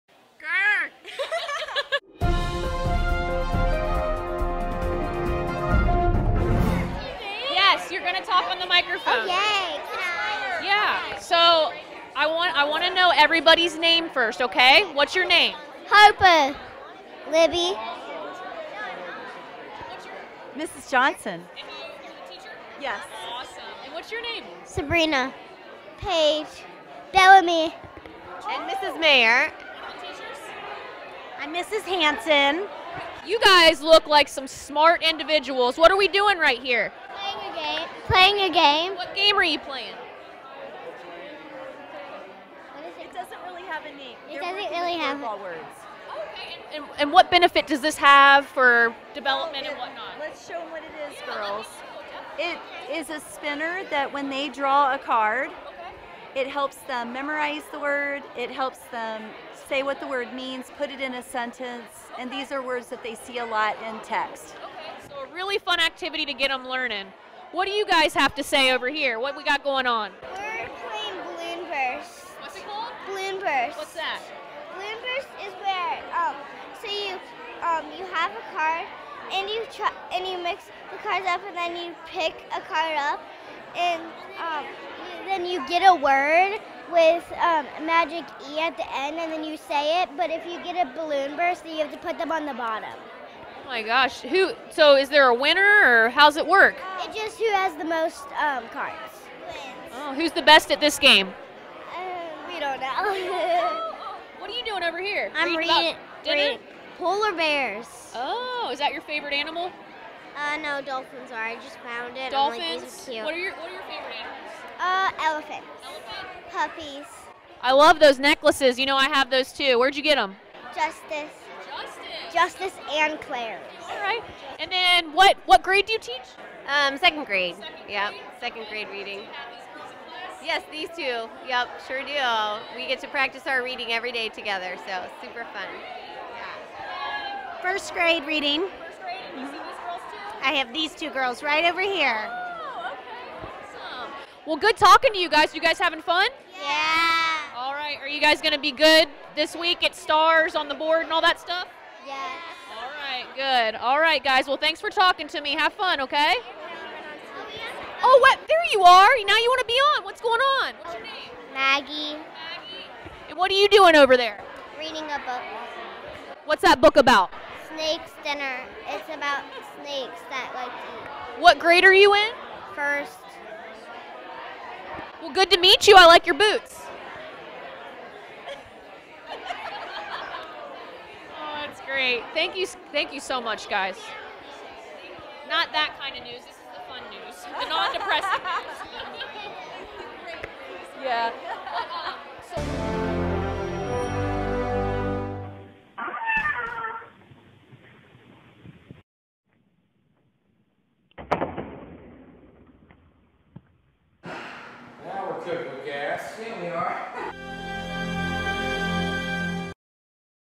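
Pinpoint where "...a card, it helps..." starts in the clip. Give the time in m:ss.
0:54.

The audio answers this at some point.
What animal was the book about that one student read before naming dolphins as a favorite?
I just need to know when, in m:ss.
1:46.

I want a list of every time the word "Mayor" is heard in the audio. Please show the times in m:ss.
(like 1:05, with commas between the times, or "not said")
0:28.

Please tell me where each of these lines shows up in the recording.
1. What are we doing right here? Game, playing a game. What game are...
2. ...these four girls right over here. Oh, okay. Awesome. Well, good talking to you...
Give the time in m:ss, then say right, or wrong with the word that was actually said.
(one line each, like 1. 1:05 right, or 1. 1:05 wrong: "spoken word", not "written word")
1. 0:35 right
2. 2:20 wrong: "two", not "four".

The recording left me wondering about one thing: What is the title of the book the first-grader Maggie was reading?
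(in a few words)
Snake's Dinner.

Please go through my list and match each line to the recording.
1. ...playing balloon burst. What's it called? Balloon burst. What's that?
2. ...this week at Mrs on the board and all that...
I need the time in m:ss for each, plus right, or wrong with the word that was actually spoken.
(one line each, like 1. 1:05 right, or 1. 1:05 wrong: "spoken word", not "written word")
1. 1:10 right
2. 2:29 wrong: "Stars", not "Mrs".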